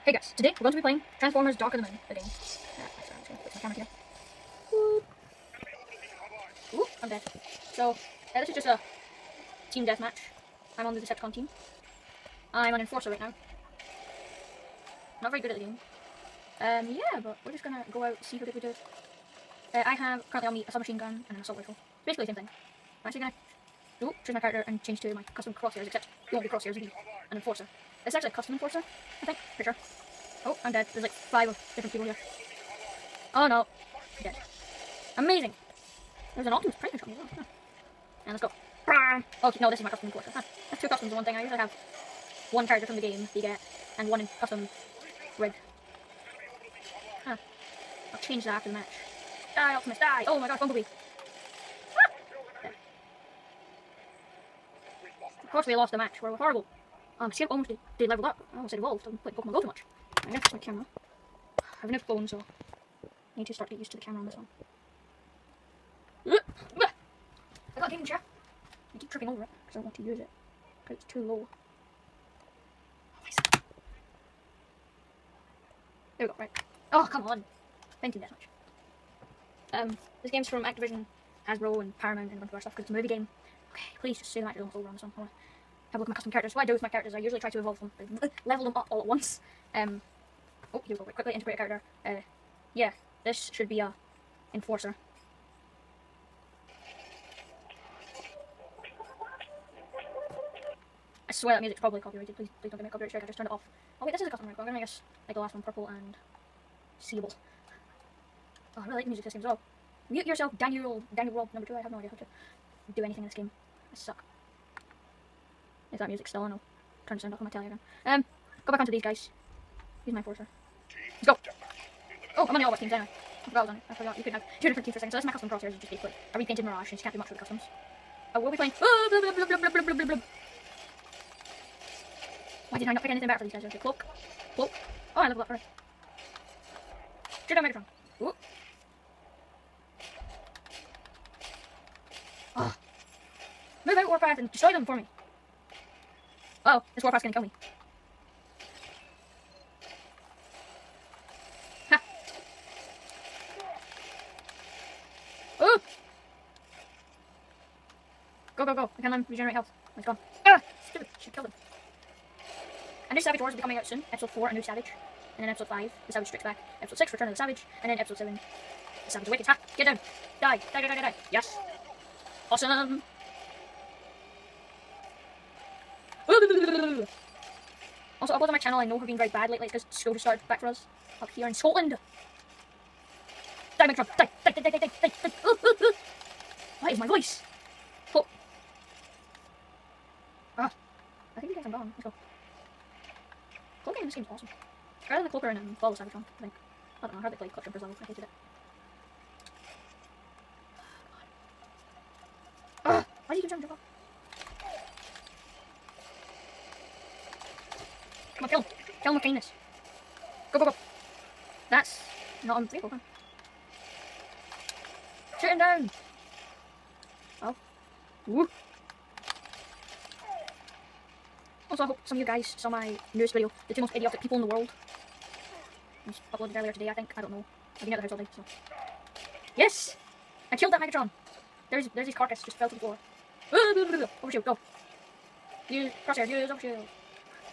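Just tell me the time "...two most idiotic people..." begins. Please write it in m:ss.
3:43.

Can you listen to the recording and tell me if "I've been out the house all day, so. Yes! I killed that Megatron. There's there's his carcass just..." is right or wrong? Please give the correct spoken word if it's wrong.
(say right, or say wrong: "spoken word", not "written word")
right.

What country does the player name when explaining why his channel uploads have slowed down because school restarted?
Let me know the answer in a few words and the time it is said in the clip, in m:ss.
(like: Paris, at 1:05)
Scotland, at 3:01.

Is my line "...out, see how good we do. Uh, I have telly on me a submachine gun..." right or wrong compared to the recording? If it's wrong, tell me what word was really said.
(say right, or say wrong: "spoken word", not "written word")
wrong: "currently", not "telly".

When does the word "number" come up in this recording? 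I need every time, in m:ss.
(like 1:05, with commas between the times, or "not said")
1:51.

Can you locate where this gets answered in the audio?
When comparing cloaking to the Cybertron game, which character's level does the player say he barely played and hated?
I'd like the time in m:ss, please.
3:17.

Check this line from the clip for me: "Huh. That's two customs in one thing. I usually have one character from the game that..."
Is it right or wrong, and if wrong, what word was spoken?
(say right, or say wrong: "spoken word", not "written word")
right.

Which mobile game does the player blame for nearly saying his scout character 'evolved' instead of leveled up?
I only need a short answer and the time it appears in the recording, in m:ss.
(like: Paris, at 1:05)
Pokemon Go, at 0:59.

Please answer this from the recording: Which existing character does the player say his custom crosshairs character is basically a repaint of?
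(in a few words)
Mirage.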